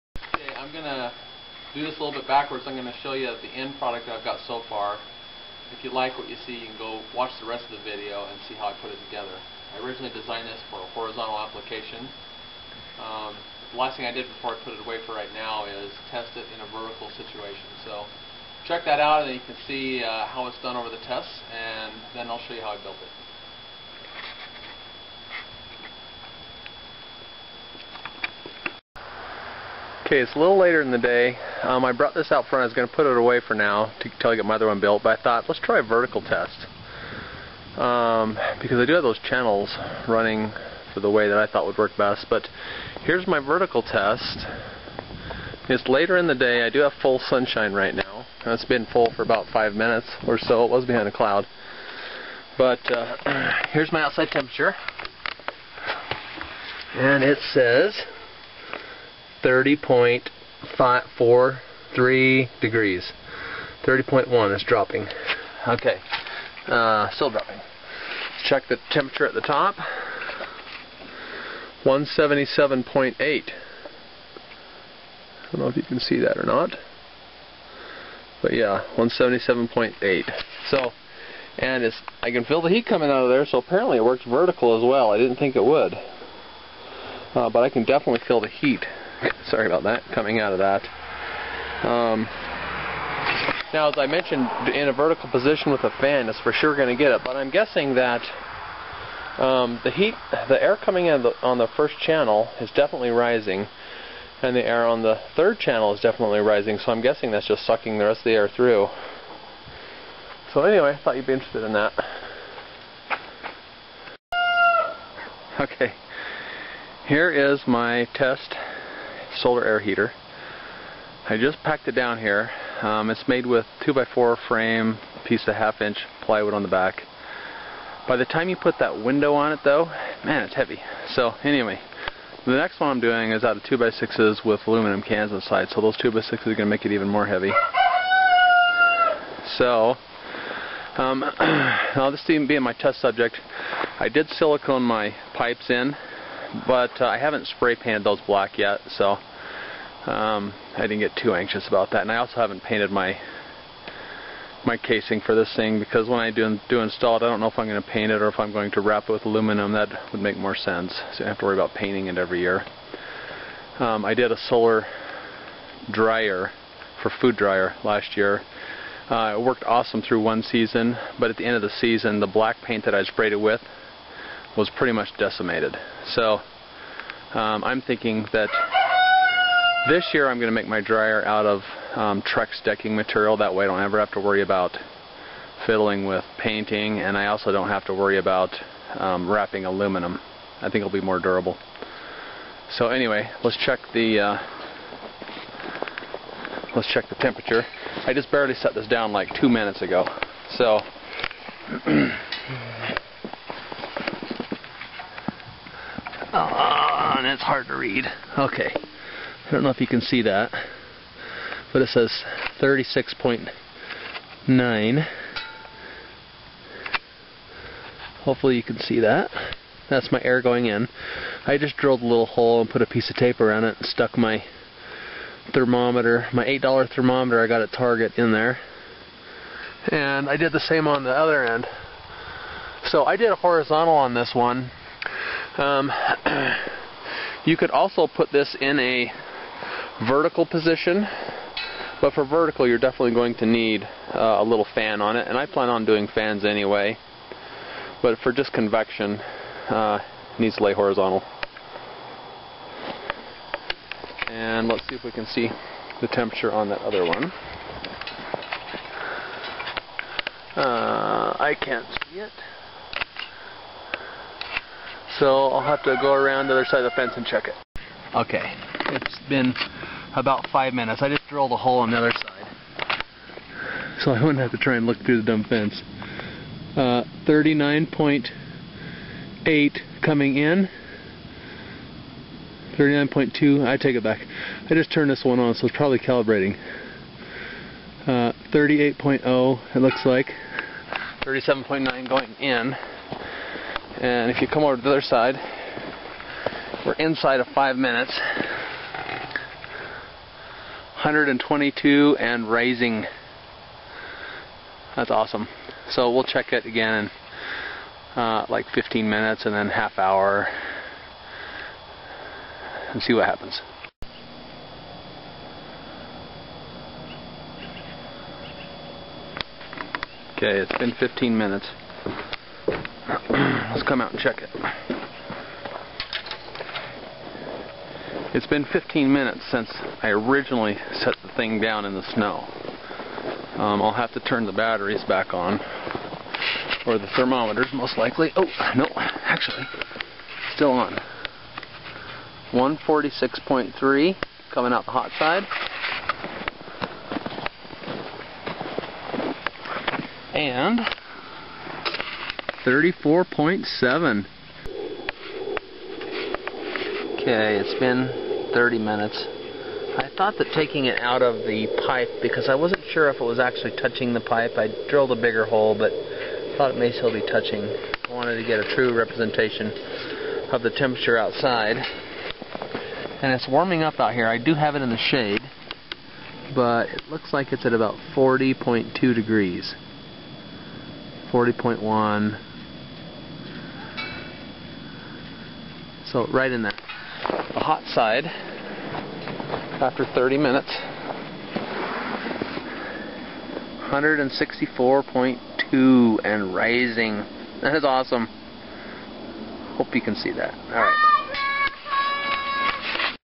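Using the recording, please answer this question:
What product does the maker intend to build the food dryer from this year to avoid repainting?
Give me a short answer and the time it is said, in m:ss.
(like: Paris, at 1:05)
Trex decking material, at 3:02.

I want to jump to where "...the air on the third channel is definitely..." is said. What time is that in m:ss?
1:44.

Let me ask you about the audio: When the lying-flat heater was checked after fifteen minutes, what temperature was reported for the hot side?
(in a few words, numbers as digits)
146.3.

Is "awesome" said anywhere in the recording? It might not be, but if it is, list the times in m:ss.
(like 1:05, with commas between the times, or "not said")
2:49, 5:05, 6:37.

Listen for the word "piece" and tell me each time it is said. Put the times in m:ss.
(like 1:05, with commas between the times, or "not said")
2:05, 3:42.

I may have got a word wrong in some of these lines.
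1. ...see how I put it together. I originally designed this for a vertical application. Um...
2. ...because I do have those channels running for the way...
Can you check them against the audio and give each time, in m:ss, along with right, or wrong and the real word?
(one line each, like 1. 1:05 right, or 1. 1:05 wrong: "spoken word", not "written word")
1. 0:08 wrong: "horizontal", not "vertical"
2. 0:38 right.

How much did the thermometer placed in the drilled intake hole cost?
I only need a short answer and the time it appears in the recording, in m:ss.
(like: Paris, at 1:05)
$8, at 3:46.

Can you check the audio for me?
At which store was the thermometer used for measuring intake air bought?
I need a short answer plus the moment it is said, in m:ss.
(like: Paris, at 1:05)
Target, at 3:47.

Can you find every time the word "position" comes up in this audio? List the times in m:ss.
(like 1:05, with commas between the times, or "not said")
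1:35, 4:00.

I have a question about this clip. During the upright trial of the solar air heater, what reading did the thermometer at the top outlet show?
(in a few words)
177.8.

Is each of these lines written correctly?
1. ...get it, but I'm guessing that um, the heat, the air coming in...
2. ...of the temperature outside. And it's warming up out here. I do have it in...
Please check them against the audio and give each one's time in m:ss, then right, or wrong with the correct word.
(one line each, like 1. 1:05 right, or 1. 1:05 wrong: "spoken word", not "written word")
1. 1:37 right
2. 6:10 right.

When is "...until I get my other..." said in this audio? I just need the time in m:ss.
0:34.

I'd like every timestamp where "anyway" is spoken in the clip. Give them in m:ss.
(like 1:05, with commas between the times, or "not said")
1:50, 2:11, 3:12, 4:06.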